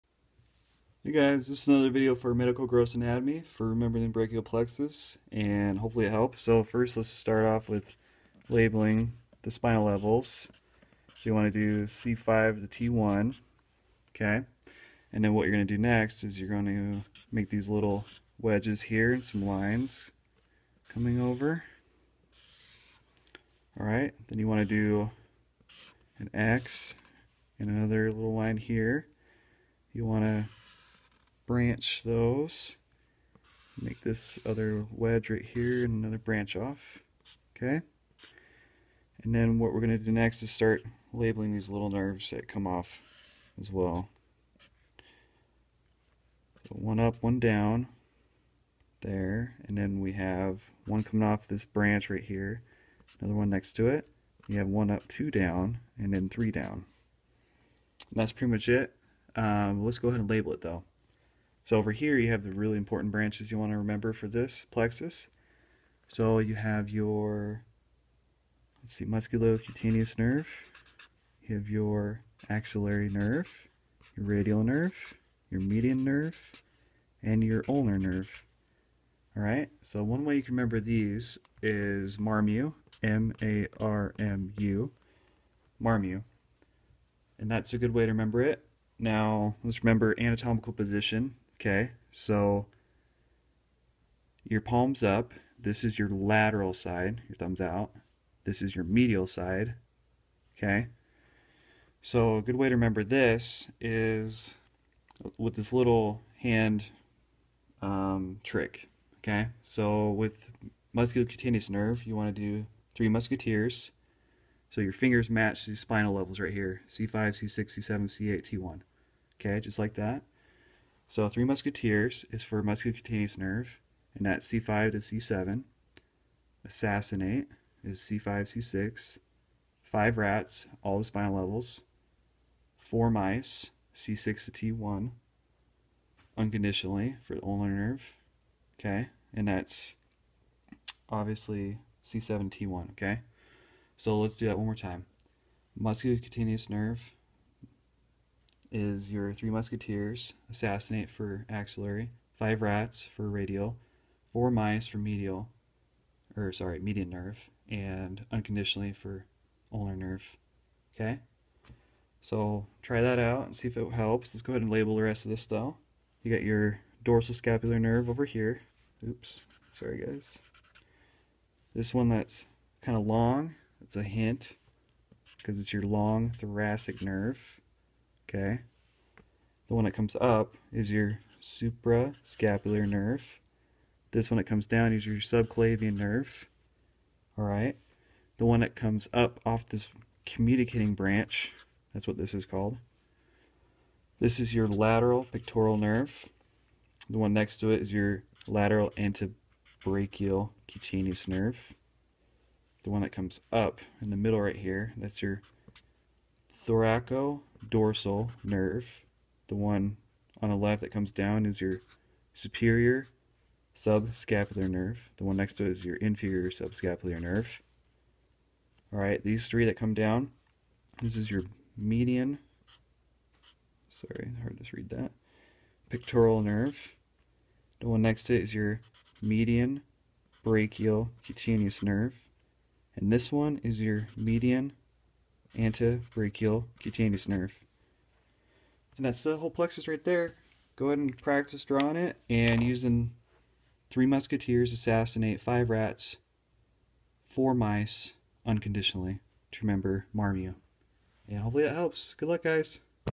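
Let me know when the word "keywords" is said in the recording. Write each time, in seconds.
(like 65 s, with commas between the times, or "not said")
not said.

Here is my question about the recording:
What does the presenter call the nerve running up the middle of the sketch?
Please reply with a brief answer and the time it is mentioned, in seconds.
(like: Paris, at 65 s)
Thoracodorsal nerve, at 206 s.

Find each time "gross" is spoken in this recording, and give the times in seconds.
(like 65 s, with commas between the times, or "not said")
2 s.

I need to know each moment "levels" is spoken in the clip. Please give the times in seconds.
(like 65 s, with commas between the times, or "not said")
9 s, 116 s, 131 s.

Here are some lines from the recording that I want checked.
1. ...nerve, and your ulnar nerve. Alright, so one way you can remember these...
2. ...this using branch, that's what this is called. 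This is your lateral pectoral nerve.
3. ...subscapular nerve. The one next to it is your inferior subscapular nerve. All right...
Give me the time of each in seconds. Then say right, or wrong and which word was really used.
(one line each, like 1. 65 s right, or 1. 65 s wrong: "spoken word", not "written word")
1. 76 s right
2. 189 s wrong: "communicating", not "using"
3. 213 s right.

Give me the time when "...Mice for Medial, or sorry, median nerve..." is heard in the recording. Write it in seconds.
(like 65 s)
154 s.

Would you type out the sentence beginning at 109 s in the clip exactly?
Okay, so with musculocutaneous nerve, you want to do three musketeers.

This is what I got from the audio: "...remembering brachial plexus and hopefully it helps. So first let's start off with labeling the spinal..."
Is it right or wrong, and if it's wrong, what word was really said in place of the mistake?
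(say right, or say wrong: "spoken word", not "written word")
right.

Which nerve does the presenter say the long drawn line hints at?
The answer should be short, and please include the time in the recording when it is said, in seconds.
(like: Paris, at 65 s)
Long thoracic nerve, at 175 s.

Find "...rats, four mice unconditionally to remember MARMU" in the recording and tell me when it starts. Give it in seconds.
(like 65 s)
245 s.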